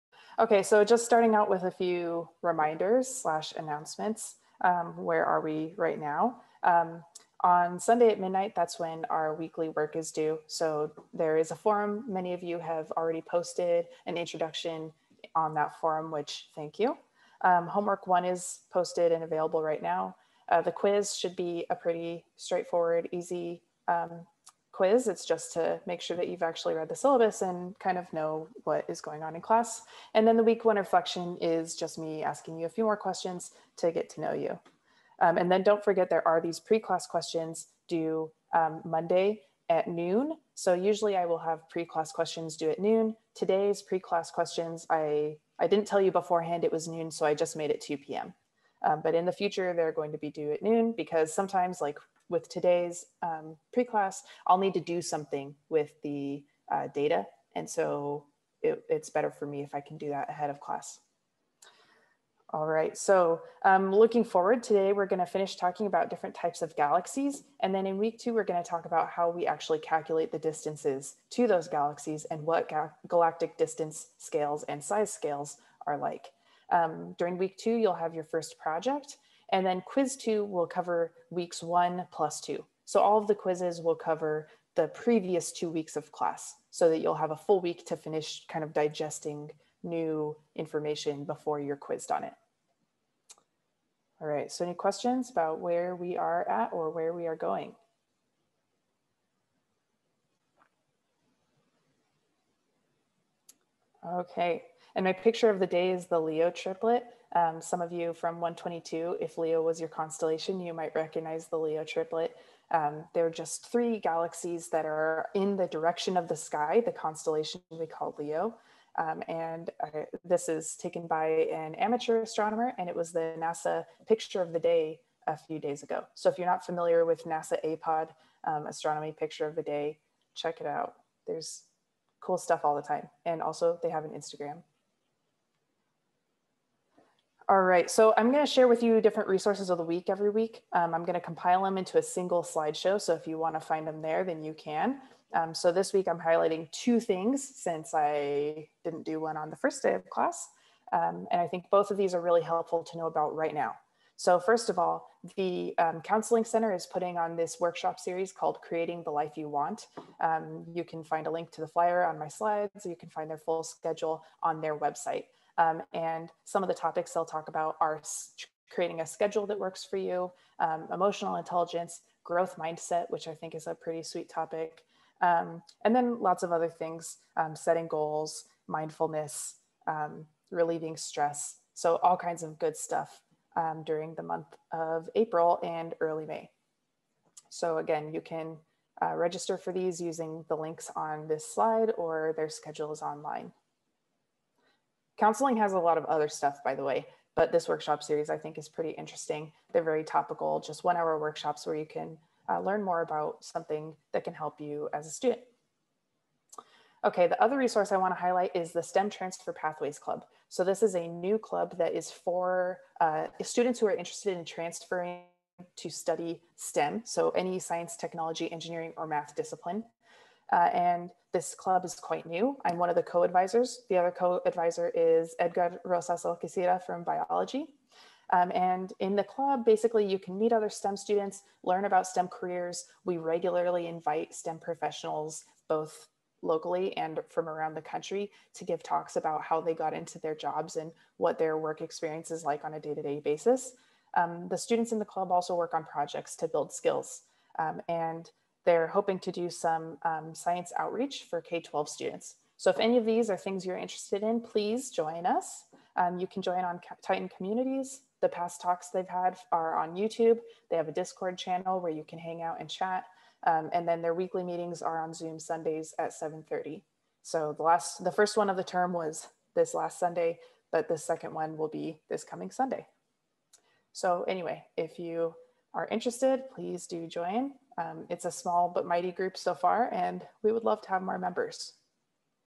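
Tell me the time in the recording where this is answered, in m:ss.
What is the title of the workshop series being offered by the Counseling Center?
2:38.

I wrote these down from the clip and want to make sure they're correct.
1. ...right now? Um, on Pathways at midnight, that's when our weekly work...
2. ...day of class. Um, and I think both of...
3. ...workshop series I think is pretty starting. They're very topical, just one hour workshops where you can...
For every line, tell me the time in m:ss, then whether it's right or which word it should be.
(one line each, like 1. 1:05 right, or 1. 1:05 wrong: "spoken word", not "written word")
1. 0:05 wrong: "Sunday", not "Pathways"
2. 2:29 right
3. 3:17 wrong: "interesting", not "starting".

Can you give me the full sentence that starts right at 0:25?
It's just to make sure that you've actually read the syllabus and kind of know what is going on in class.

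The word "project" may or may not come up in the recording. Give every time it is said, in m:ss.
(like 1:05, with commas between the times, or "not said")
1:18, 4:05.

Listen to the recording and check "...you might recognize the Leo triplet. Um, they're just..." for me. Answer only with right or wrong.
right.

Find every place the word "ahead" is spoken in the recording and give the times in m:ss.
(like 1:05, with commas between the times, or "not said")
1:00.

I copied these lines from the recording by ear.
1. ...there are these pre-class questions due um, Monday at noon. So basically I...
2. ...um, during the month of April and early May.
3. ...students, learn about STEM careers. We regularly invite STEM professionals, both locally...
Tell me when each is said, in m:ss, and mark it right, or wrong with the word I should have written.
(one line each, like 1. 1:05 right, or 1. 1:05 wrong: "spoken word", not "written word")
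1. 0:36 wrong: "usually", not "basically"
2. 3:03 right
3. 3:50 right.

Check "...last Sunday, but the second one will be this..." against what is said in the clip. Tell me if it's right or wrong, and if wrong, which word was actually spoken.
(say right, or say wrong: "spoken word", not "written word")
right.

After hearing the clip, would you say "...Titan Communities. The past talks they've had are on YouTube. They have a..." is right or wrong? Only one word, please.
right.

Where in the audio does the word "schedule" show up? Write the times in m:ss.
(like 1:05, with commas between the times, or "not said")
2:43, 2:49, 3:12.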